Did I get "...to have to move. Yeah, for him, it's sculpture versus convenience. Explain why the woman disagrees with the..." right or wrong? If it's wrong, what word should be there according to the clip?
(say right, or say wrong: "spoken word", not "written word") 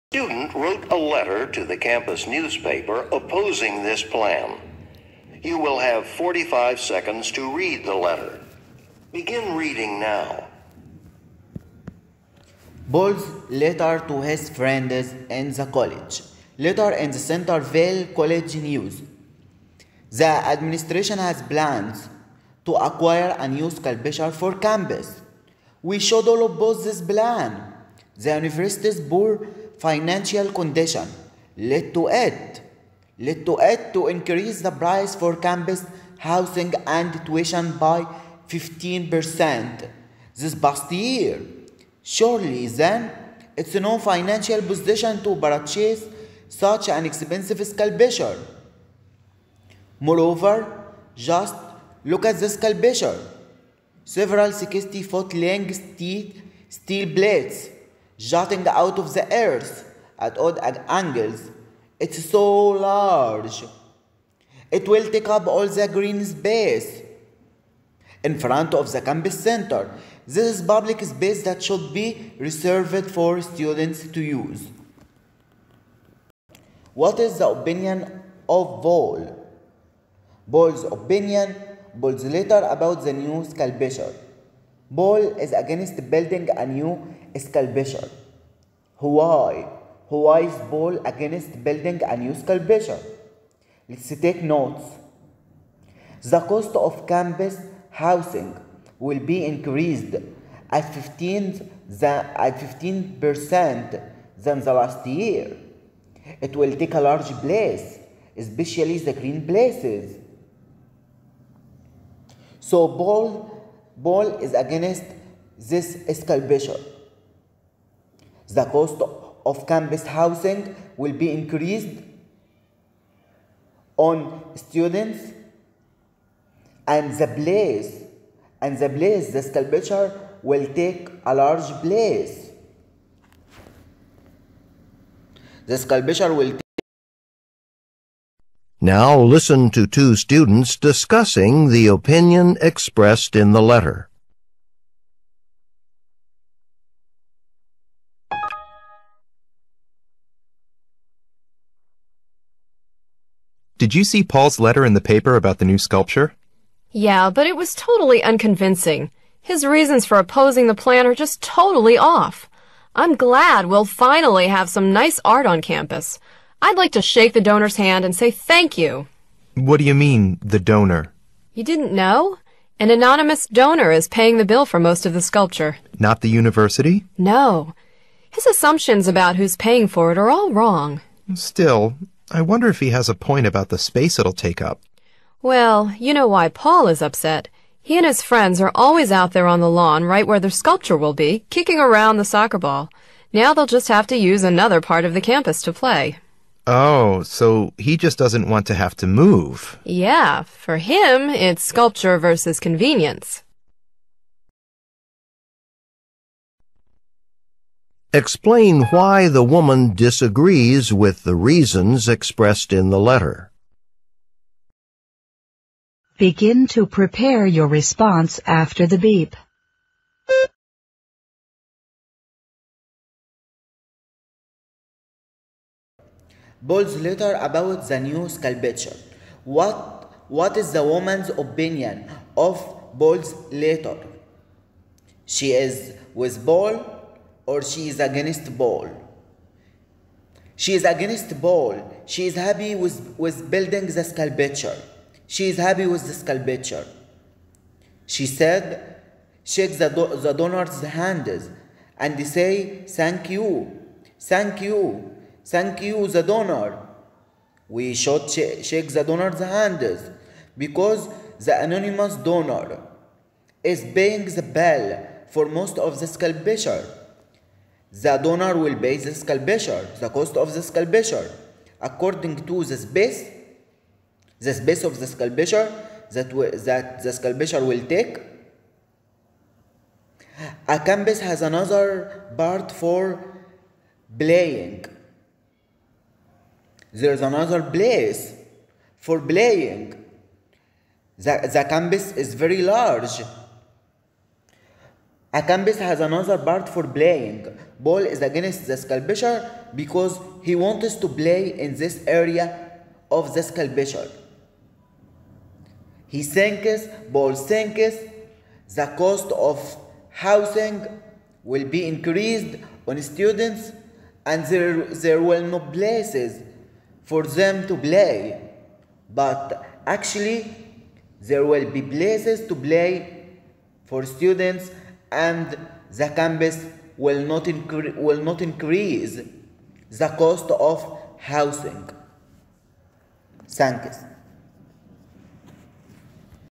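right.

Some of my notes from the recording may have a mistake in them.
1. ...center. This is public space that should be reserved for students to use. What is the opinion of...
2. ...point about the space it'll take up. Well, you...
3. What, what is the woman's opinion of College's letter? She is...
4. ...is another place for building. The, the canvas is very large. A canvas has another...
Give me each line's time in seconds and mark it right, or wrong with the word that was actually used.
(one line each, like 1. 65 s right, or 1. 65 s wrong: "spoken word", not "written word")
1. 69 s right
2. 183 s right
3. 229 s wrong: "Bold", not "College"
4. 287 s wrong: "playing", not "building".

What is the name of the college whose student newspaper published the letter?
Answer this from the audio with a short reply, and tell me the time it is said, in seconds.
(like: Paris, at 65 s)
Centerville College, at 17 s.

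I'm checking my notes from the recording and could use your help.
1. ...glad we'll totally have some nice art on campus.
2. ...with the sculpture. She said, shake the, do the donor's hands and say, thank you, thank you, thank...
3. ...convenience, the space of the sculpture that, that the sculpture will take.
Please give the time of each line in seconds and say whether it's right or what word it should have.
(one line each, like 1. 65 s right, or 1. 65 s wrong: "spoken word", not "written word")
1. 163 s wrong: "finally", not "totally"
2. 245 s right
3. 272 s wrong: "space", not "convenience".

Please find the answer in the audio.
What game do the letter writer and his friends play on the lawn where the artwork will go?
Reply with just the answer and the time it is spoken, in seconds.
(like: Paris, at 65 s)
Soccer, at 192 s.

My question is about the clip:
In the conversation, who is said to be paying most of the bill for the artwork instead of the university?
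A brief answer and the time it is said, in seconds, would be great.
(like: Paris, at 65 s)
An anonymous donor, at 172 s.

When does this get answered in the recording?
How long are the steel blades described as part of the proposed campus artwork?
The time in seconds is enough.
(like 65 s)
54 s.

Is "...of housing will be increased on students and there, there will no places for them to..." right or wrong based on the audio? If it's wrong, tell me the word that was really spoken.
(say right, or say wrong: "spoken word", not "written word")
right.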